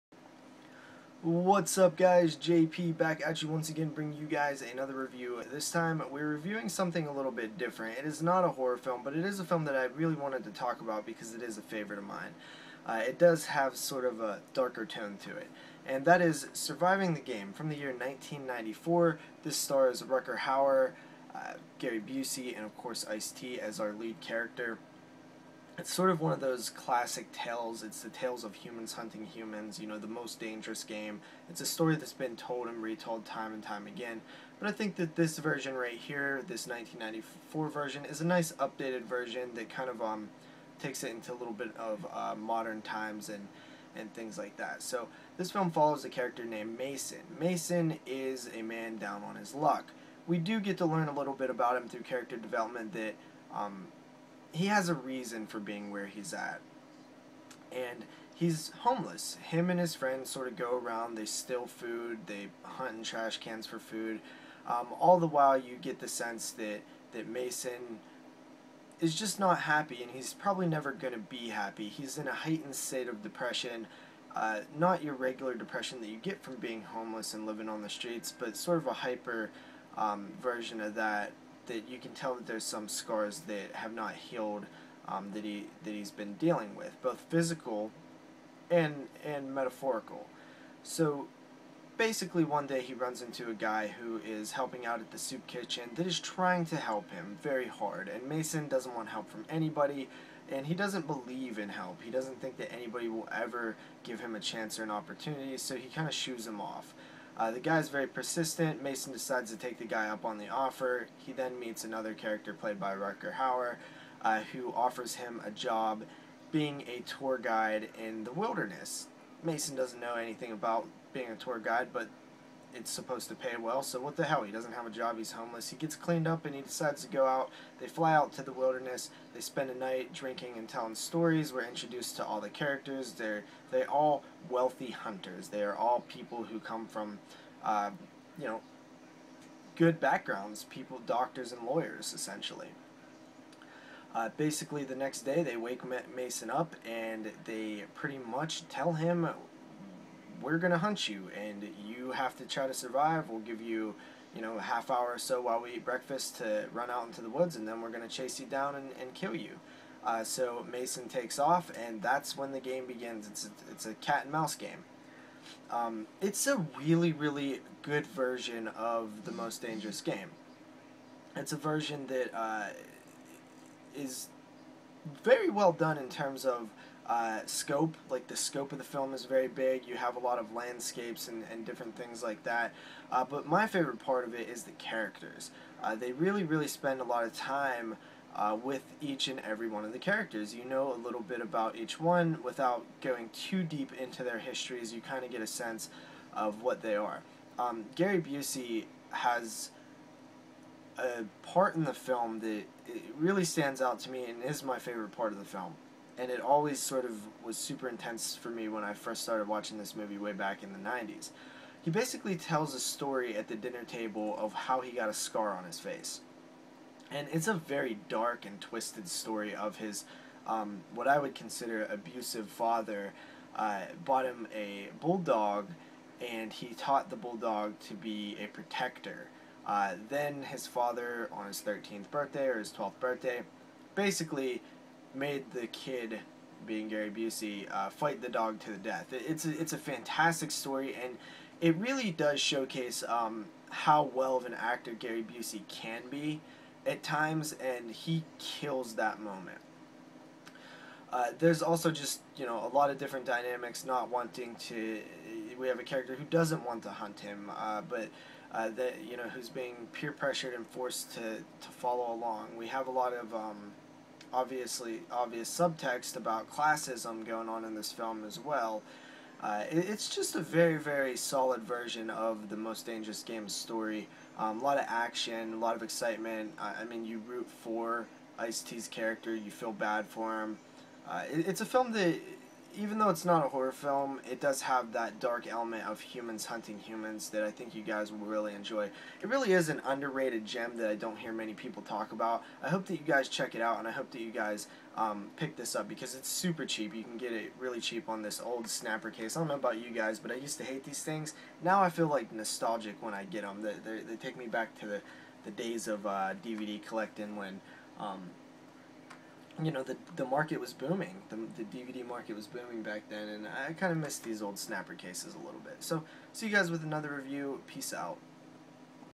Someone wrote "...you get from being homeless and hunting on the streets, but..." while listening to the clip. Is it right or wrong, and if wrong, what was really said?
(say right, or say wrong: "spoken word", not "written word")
wrong: "living", not "hunting".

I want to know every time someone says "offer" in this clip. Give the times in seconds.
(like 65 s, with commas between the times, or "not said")
110 s, 114 s.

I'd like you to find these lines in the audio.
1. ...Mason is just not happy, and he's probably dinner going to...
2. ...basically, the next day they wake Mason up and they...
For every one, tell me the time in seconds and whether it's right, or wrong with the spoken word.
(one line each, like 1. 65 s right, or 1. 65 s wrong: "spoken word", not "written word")
1. 67 s wrong: "never", not "dinner"
2. 144 s right.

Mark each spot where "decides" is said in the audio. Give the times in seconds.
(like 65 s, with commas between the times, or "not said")
109 s, 126 s.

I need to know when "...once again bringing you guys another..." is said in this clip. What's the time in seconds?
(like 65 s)
3 s.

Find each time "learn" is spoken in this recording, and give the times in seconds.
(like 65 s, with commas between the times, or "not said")
50 s.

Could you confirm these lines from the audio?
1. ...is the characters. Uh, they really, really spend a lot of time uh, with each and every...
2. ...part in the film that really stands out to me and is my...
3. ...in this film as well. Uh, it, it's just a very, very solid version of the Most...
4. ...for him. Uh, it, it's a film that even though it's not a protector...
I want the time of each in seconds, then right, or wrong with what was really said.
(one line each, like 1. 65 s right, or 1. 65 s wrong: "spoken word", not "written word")
1. 184 s right
2. 201 s right
3. 267 s right
4. 280 s wrong: "horror", not "protector".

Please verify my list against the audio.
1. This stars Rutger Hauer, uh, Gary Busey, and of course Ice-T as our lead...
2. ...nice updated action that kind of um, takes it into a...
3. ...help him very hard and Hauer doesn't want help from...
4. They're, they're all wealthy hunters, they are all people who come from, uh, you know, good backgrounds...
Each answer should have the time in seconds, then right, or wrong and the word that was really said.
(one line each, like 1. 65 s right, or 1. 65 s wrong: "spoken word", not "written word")
1. 19 s right
2. 38 s wrong: "version", not "action"
3. 96 s wrong: "Mason", not "Hauer"
4. 133 s right.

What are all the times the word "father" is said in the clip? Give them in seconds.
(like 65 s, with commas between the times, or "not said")
222 s, 230 s.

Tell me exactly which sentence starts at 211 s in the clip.
He basically tells a story at the dinner table of how he got a scar on his face.